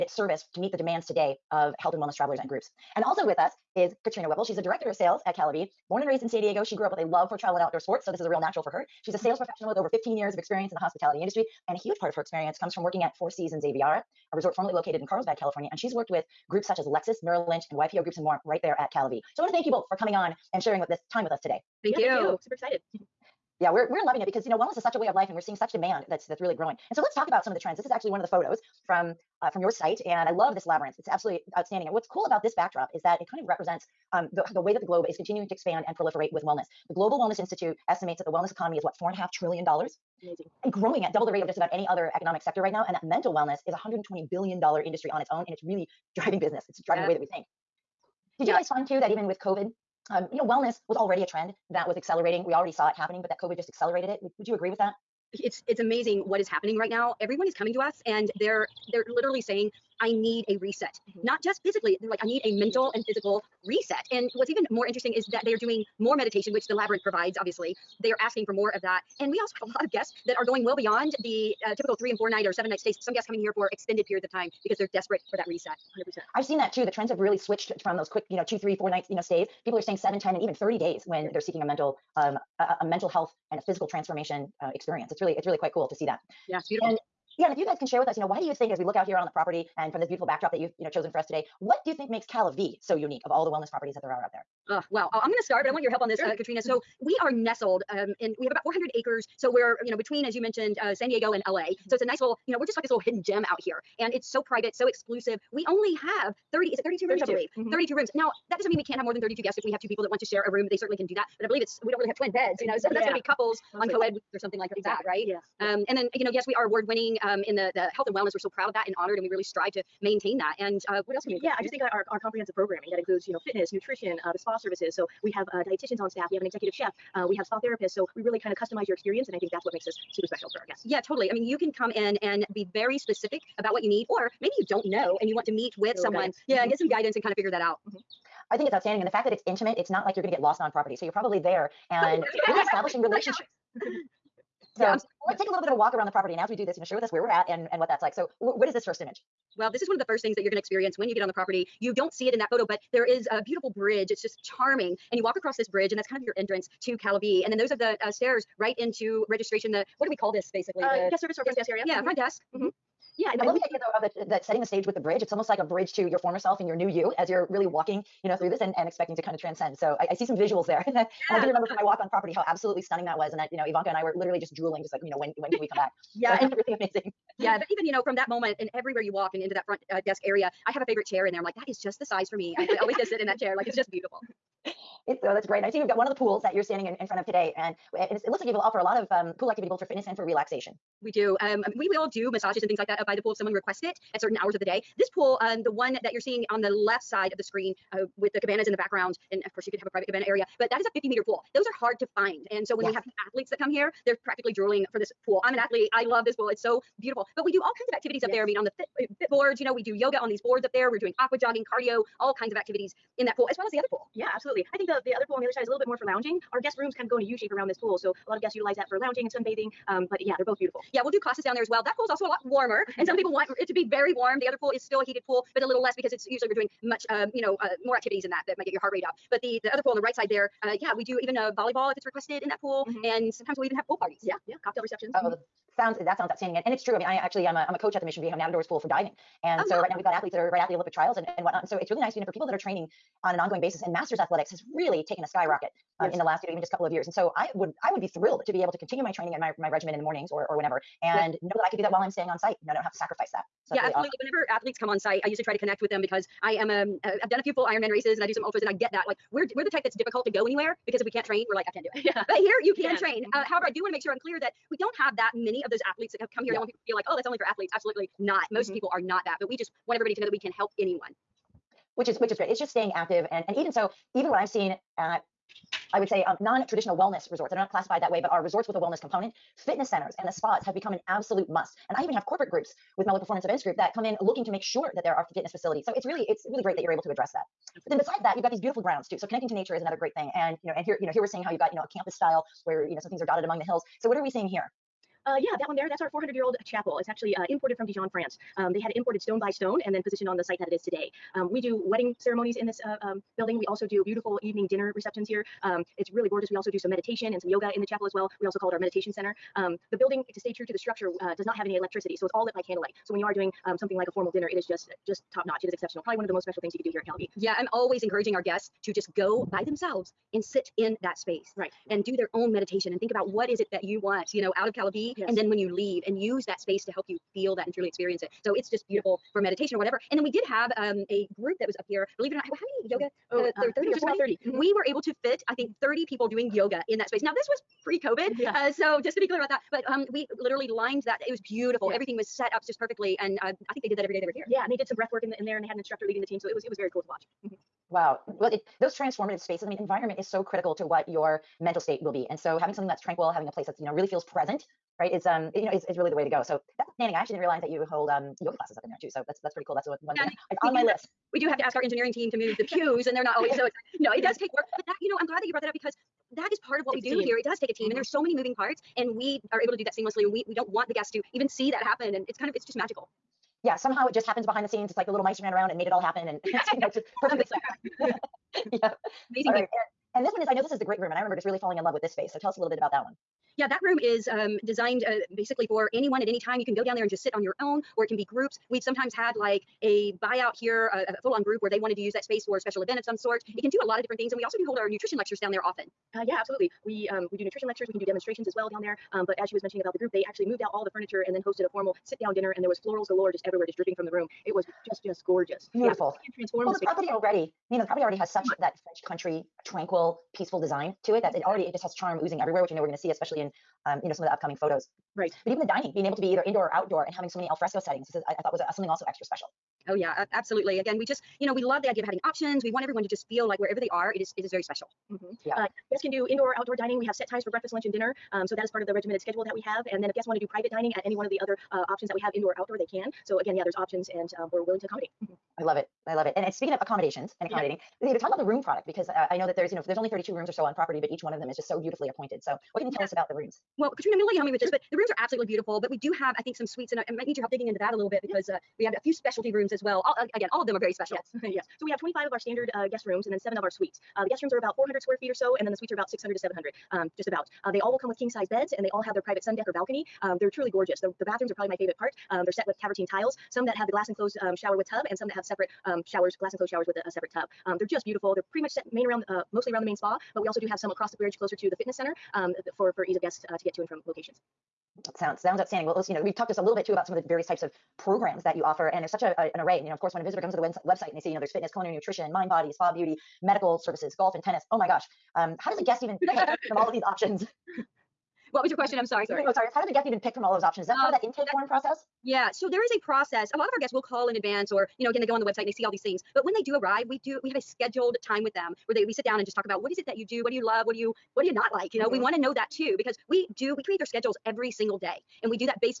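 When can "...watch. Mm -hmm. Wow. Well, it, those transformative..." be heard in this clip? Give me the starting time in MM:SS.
05:47.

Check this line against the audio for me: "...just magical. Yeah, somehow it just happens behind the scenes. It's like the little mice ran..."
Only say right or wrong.
right.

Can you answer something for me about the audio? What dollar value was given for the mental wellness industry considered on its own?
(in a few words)
$120 billion.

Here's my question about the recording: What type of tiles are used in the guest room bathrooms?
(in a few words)
Travertine.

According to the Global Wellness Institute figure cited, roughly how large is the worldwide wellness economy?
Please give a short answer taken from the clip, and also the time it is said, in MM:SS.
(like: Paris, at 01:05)
4.5 trillion dollars, at 00:39.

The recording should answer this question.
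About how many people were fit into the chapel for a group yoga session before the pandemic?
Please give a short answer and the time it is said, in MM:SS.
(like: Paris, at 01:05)
30, at 05:35.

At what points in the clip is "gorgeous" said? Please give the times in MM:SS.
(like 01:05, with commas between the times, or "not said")
05:06, 06:45, 07:40.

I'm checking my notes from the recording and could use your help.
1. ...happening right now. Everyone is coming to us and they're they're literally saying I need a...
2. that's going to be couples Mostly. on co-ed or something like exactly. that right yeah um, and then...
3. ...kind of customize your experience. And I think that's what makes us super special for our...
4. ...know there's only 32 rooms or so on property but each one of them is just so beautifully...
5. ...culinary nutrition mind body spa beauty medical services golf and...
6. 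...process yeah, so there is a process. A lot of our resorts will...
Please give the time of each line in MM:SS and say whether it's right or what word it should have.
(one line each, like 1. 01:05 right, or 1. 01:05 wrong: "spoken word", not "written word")
1. 00:56 right
2. 01:52 right
3. 02:08 right
4. 07:19 right
5. 08:01 right
6. 08:11 wrong: "guests", not "resorts".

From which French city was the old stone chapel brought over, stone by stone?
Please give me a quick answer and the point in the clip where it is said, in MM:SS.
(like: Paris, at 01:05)
Dijon, at 04:57.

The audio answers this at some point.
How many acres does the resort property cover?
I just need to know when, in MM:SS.
01:38.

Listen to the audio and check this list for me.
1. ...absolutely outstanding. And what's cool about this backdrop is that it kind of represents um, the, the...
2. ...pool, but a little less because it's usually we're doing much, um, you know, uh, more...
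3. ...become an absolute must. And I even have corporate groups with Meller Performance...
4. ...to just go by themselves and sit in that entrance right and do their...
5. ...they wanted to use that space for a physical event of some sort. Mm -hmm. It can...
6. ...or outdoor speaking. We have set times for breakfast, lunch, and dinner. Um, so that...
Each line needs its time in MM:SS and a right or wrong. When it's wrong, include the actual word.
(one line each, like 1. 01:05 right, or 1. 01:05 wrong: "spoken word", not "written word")
1. 00:31 right
2. 03:45 right
3. 04:40 right
4. 05:18 wrong: "space", not "entrance"
5. 06:31 wrong: "special", not "physical"
6. 07:06 wrong: "dining", not "speaking".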